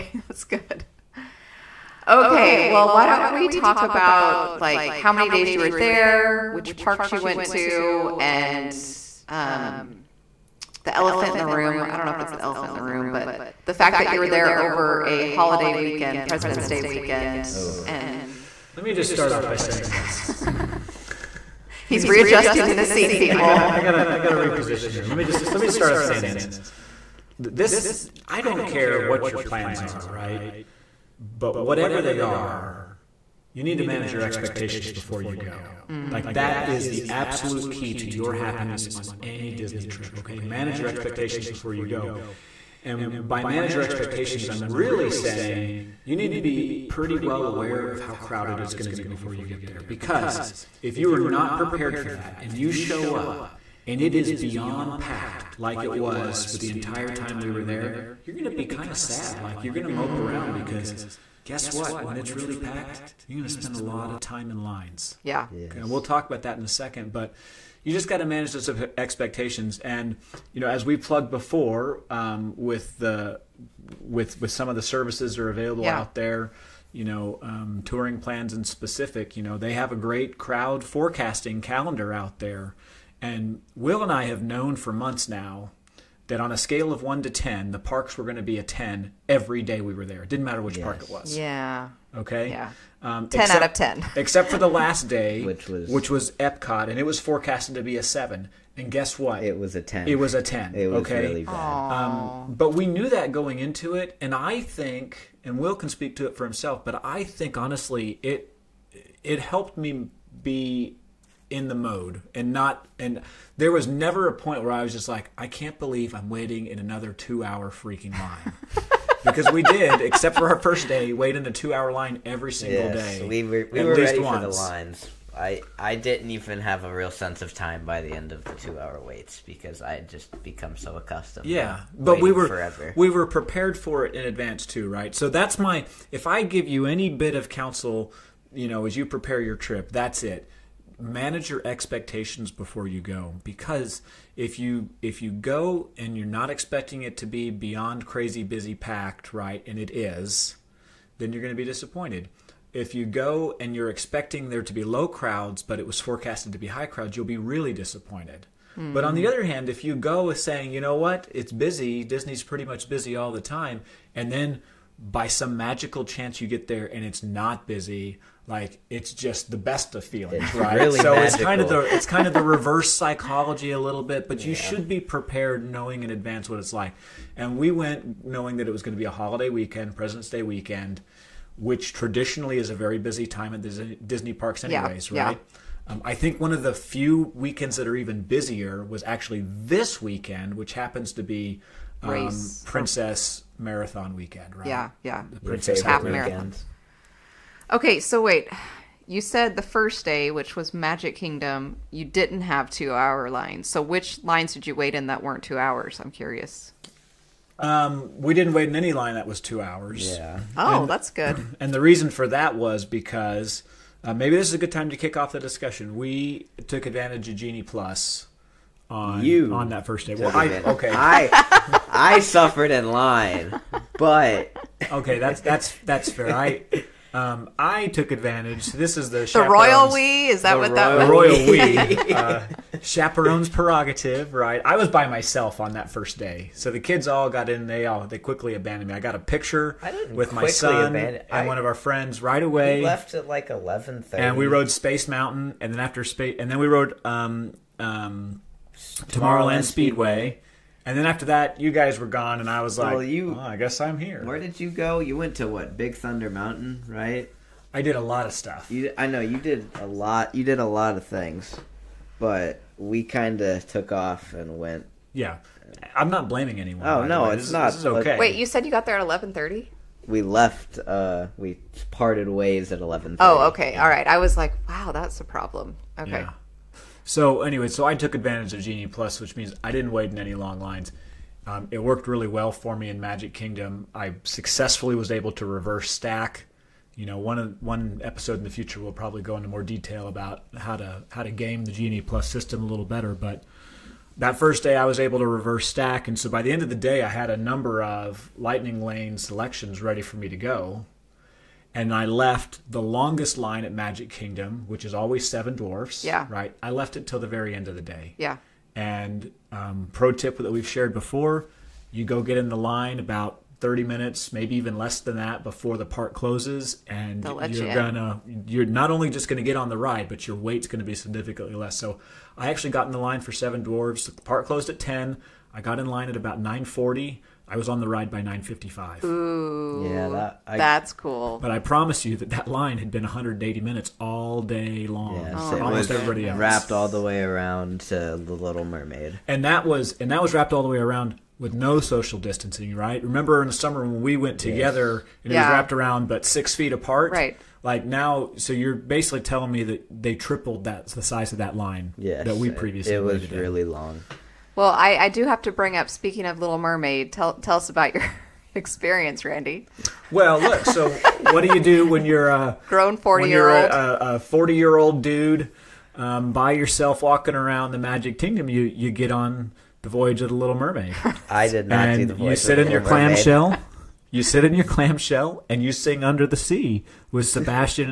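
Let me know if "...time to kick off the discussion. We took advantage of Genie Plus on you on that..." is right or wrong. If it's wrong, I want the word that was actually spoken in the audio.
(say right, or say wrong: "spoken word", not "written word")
right.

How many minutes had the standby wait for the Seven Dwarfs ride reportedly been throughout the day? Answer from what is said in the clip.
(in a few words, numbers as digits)
180.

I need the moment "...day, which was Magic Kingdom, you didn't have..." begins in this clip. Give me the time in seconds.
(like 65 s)
200 s.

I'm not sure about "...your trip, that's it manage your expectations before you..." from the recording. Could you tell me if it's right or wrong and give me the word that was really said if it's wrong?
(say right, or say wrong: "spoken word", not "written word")
right.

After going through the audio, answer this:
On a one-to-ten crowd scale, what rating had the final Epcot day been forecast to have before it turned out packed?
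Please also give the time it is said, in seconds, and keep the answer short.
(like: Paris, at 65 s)
7, at 98 s.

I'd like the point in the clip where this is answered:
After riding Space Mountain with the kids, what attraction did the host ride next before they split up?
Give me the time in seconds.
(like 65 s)
248 s.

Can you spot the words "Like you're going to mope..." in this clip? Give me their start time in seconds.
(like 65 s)
59 s.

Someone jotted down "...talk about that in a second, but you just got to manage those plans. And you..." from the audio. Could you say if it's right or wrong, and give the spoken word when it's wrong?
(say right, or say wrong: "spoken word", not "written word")
wrong: "expectations", not "plans".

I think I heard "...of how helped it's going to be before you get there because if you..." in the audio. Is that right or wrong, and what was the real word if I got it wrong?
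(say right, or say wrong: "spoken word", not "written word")
wrong: "crowded", not "helped".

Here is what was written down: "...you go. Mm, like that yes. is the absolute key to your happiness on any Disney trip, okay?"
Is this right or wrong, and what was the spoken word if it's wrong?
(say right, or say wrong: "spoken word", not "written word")
right.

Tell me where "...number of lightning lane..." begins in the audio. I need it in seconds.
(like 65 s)
297 s.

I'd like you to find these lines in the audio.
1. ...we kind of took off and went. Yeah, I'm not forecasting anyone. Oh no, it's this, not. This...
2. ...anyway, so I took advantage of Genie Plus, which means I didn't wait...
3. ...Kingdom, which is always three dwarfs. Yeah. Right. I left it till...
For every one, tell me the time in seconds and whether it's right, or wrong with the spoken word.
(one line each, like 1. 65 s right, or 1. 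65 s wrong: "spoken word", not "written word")
1. 262 s wrong: "blaming", not "forecasting"
2. 277 s right
3. 304 s wrong: "seven", not "three".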